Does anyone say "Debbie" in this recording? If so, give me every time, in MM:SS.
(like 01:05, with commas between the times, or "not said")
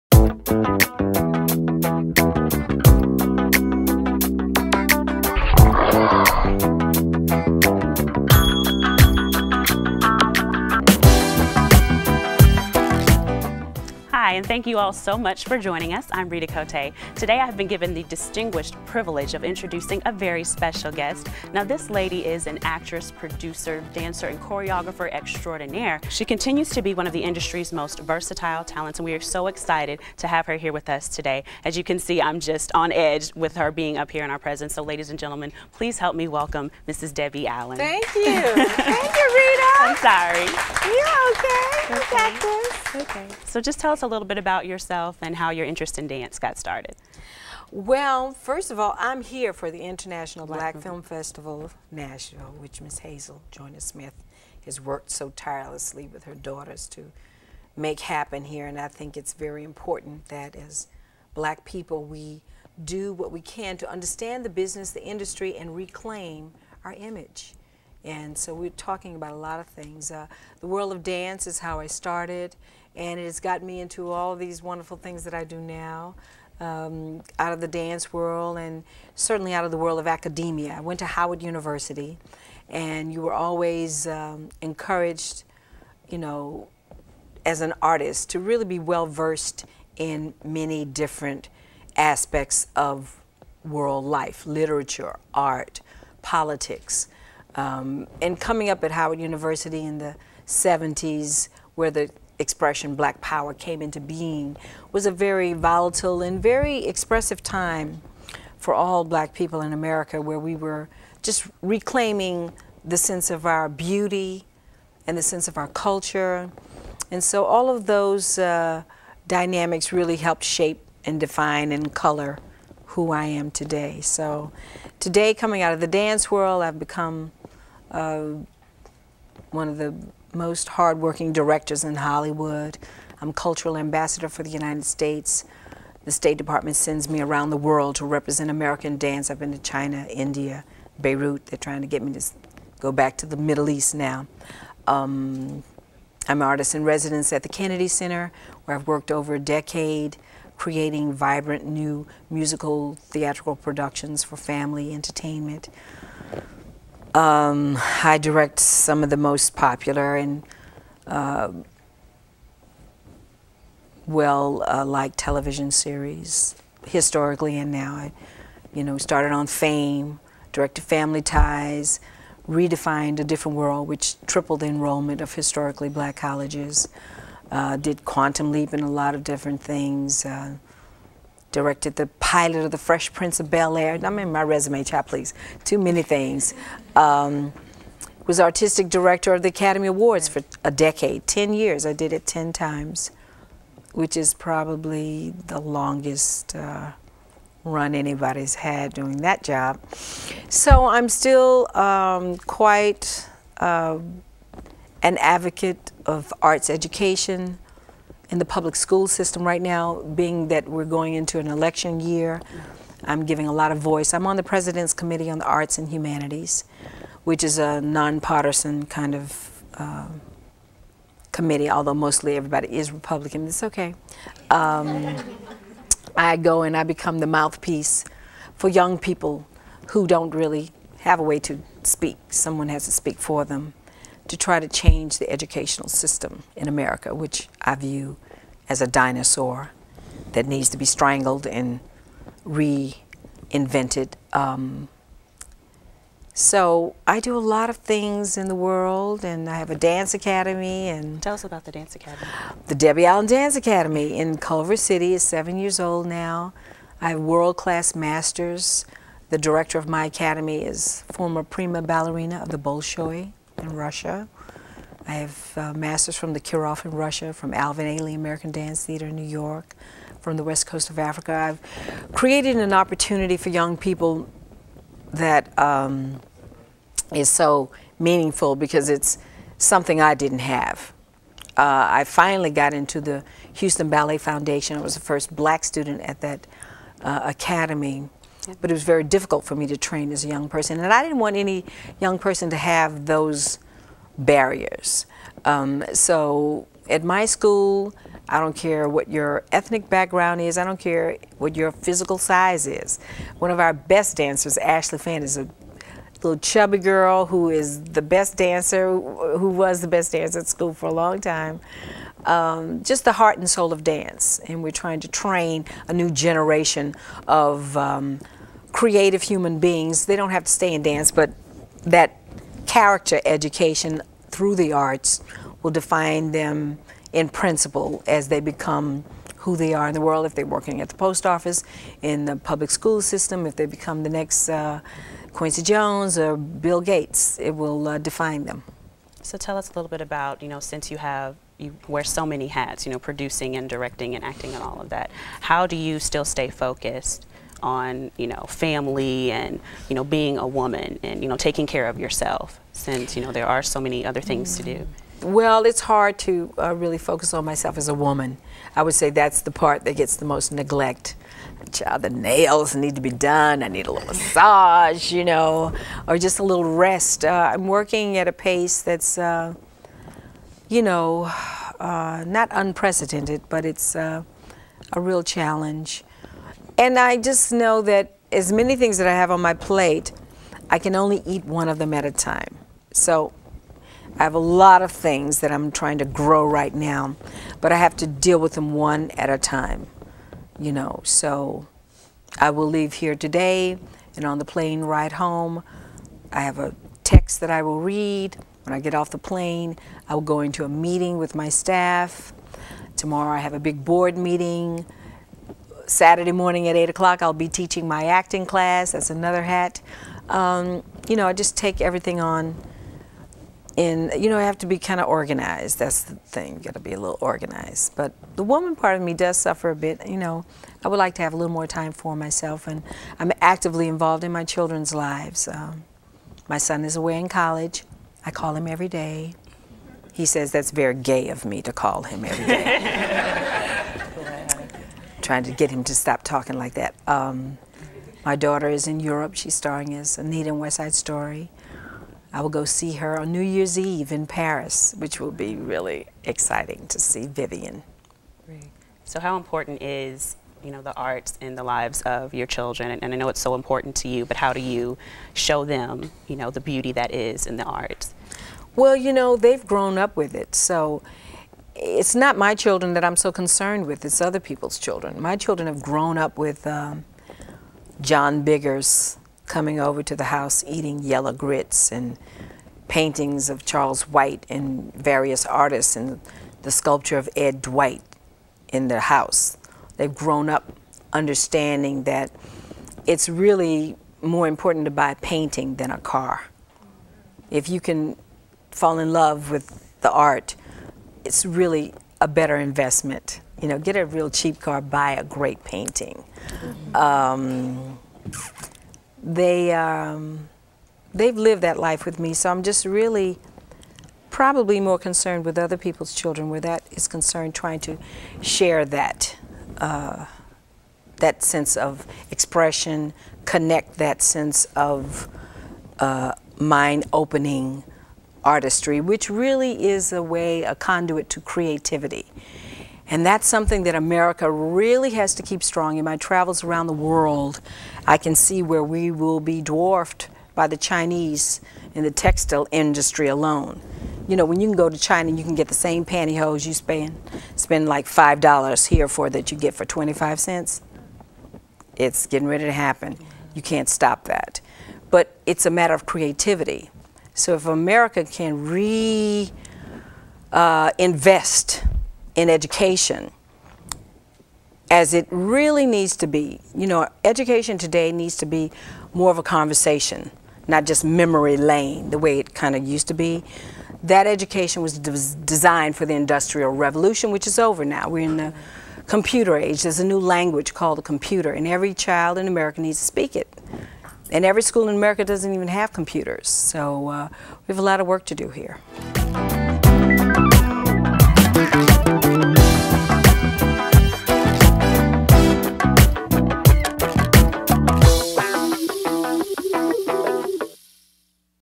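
00:37, 04:12.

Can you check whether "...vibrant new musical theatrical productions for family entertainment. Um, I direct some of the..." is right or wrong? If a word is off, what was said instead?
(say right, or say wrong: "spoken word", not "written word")
right.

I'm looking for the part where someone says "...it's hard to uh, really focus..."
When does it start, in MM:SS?
05:55.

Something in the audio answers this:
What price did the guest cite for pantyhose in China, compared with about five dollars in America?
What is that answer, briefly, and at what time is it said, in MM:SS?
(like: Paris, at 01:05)
25 cents, at 08:59.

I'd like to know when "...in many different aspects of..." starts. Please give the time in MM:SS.
01:29.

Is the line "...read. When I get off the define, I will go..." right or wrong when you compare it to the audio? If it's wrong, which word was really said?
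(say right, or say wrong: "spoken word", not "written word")
wrong: "plane", not "define".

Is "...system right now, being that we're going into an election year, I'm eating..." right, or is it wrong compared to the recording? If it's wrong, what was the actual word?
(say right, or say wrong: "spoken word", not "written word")
wrong: "giving", not "eating".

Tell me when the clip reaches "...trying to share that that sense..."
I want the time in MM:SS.
08:27.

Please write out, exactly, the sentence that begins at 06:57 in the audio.
But the woman part of me does suffer a bit.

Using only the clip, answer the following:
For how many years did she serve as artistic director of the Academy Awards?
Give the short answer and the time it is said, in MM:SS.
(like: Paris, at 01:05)
10, at 03:11.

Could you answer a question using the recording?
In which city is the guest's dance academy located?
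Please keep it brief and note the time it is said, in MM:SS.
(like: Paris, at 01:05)
Culver City, at 04:14.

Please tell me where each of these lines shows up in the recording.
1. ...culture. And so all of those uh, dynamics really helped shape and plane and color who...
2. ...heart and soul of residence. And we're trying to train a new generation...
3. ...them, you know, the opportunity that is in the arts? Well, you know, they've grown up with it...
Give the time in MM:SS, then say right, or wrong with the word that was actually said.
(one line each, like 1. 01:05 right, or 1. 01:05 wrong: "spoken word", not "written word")
1. 01:55 wrong: "define", not "plane"
2. 05:13 wrong: "dance", not "residence"
3. 07:35 wrong: "beauty", not "opportunity".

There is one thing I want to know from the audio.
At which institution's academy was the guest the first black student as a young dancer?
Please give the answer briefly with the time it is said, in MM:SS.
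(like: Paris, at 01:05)
Houston Ballet Foundation, at 04:43.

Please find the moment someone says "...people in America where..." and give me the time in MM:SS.
01:49.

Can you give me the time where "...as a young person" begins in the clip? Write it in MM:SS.
04:50.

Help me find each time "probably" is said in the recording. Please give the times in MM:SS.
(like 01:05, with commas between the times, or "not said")
03:14, 08:24.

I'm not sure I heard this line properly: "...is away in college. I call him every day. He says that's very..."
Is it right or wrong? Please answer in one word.
right.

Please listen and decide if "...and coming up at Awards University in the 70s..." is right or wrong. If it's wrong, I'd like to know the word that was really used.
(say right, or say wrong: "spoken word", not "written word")
wrong: "Howard", not "Awards".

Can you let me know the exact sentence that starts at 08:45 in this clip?
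In my travels around the world, I can see where we will be dwarfed by the Chinese in the textile industry alone.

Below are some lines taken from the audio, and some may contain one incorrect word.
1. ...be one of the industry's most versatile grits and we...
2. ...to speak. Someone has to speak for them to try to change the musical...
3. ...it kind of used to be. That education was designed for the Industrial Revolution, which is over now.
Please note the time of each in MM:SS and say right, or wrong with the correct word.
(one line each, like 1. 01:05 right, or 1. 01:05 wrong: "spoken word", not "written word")
1. 00:26 wrong: "talents", not "grits"
2. 03:51 wrong: "educational", not "musical"
3. 09:22 right.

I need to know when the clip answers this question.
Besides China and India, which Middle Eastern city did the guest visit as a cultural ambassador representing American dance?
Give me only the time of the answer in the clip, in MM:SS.
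02:20.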